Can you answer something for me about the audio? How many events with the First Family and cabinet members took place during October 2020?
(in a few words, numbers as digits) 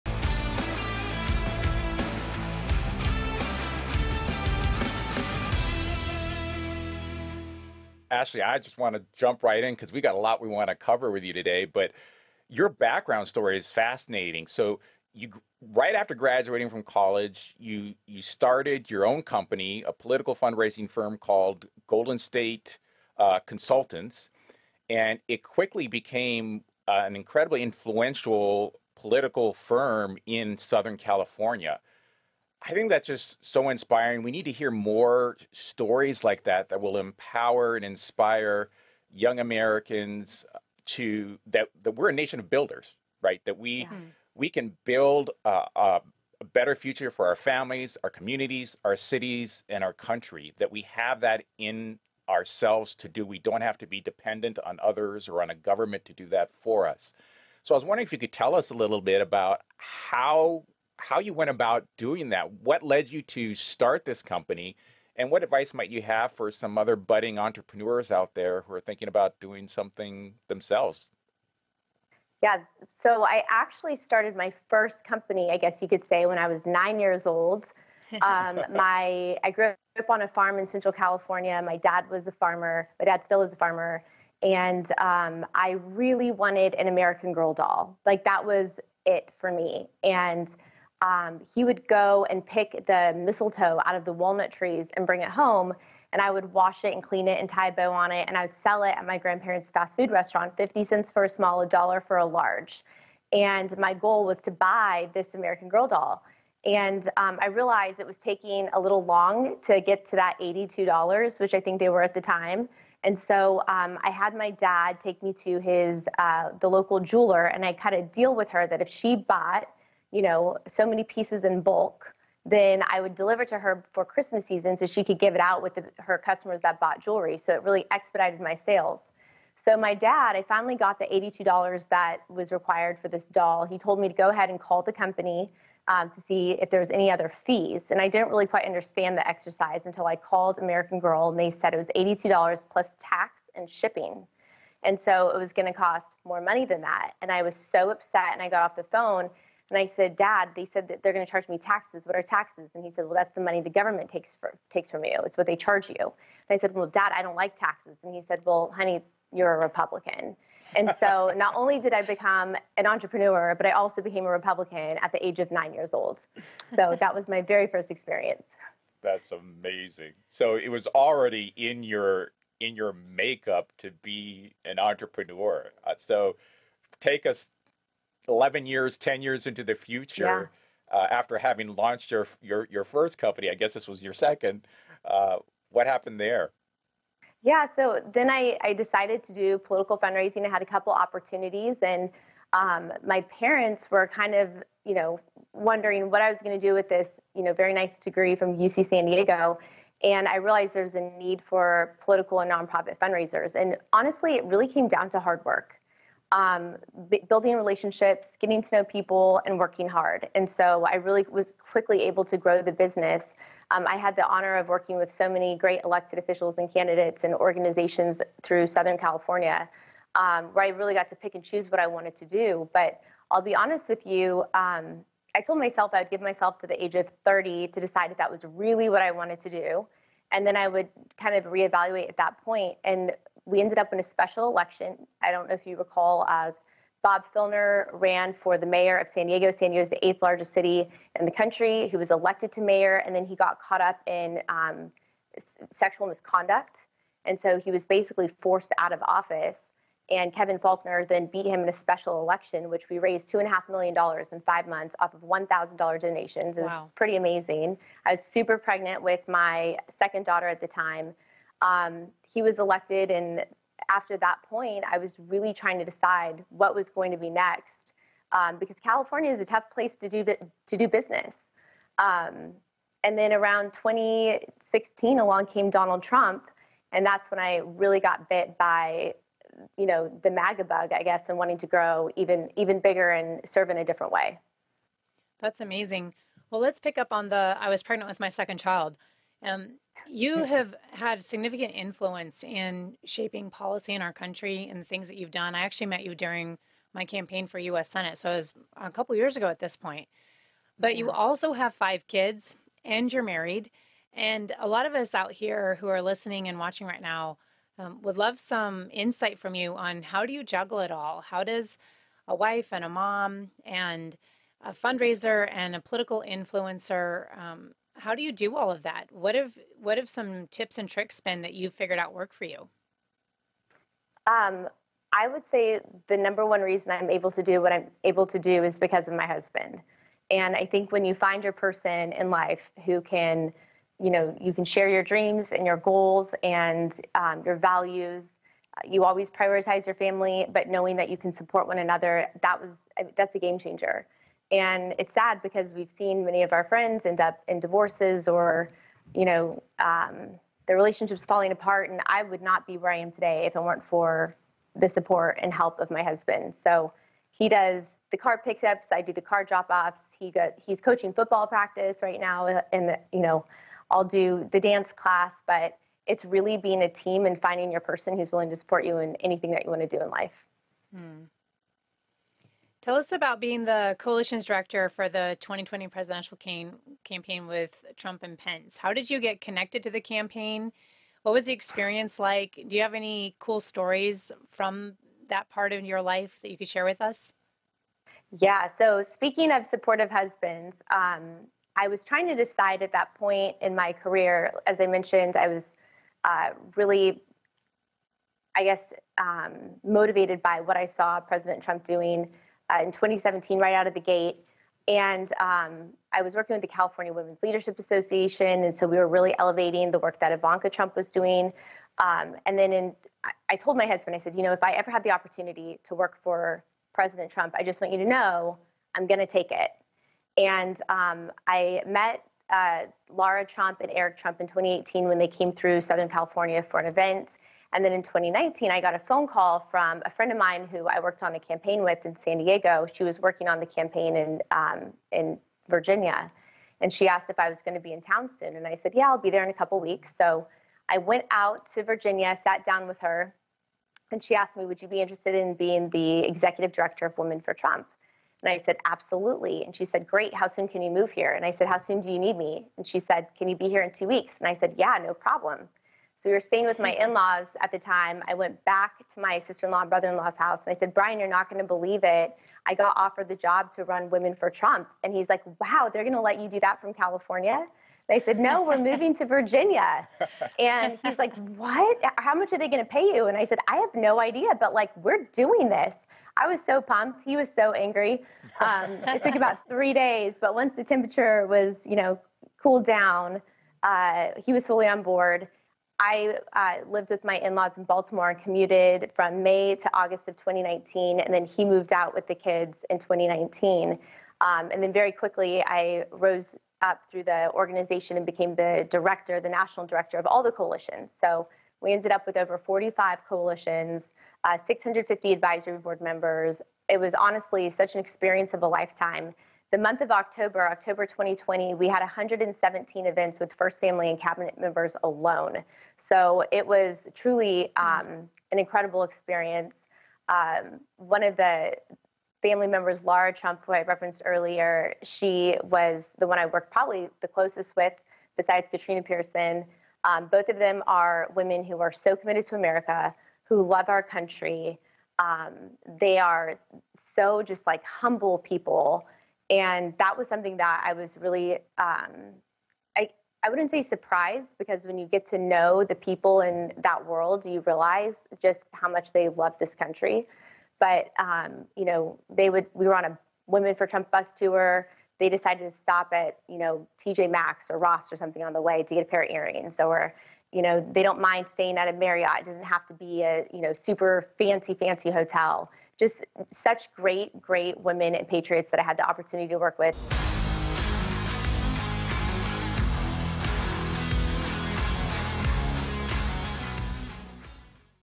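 117.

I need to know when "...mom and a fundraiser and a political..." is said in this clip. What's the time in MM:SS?
05:12.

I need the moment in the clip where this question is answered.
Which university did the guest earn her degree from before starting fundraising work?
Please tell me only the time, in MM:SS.
03:18.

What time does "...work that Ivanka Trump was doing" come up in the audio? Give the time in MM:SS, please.
06:49.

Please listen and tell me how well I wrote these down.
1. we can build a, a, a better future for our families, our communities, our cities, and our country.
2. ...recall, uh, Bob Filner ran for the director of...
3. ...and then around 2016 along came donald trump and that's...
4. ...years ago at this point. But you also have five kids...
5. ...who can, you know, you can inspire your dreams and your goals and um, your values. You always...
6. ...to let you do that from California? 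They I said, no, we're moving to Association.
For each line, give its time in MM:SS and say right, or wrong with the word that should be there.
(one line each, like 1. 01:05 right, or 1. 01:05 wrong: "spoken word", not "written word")
1. 00:44 right
2. 03:55 wrong: "mayor", not "director"
3. 04:33 right
4. 04:59 right
5. 05:32 wrong: "share", not "inspire"
6. 07:46 wrong: "Virginia", not "Association".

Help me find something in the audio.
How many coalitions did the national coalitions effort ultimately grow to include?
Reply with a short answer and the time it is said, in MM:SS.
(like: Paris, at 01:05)
over 45, at 08:22.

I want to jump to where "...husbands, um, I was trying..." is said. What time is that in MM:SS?
06:30.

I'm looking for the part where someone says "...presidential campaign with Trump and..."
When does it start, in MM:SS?
06:15.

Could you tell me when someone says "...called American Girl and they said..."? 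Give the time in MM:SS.
02:20.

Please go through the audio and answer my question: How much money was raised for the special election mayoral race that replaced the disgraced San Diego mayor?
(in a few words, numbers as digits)
$2.5 million.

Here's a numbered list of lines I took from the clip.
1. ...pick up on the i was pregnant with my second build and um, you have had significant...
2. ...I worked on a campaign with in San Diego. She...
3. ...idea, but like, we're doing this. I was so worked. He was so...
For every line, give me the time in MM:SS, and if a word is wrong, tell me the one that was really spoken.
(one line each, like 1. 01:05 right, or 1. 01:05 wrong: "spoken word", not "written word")
1. 04:46 wrong: "child", not "build"
2. 07:10 right
3. 07:54 wrong: "pumped", not "worked".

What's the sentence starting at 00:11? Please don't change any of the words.
But your background story is fascinating.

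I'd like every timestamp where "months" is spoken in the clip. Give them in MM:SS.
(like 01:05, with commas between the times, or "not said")
04:14, 08:29.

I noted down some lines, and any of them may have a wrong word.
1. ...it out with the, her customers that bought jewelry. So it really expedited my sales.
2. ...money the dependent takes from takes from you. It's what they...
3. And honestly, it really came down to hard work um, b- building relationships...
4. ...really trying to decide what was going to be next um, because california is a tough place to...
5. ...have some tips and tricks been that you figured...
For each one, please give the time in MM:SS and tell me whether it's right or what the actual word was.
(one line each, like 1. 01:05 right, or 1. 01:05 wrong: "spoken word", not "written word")
1. 02:05 right
2. 02:33 wrong: "government", not "dependent"
3. 03:23 right
4. 04:25 right
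5. 05:19 right.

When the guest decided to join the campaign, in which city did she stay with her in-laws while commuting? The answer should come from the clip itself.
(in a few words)
Baltimore.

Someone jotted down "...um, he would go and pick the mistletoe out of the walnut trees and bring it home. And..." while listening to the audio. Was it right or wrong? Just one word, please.
right.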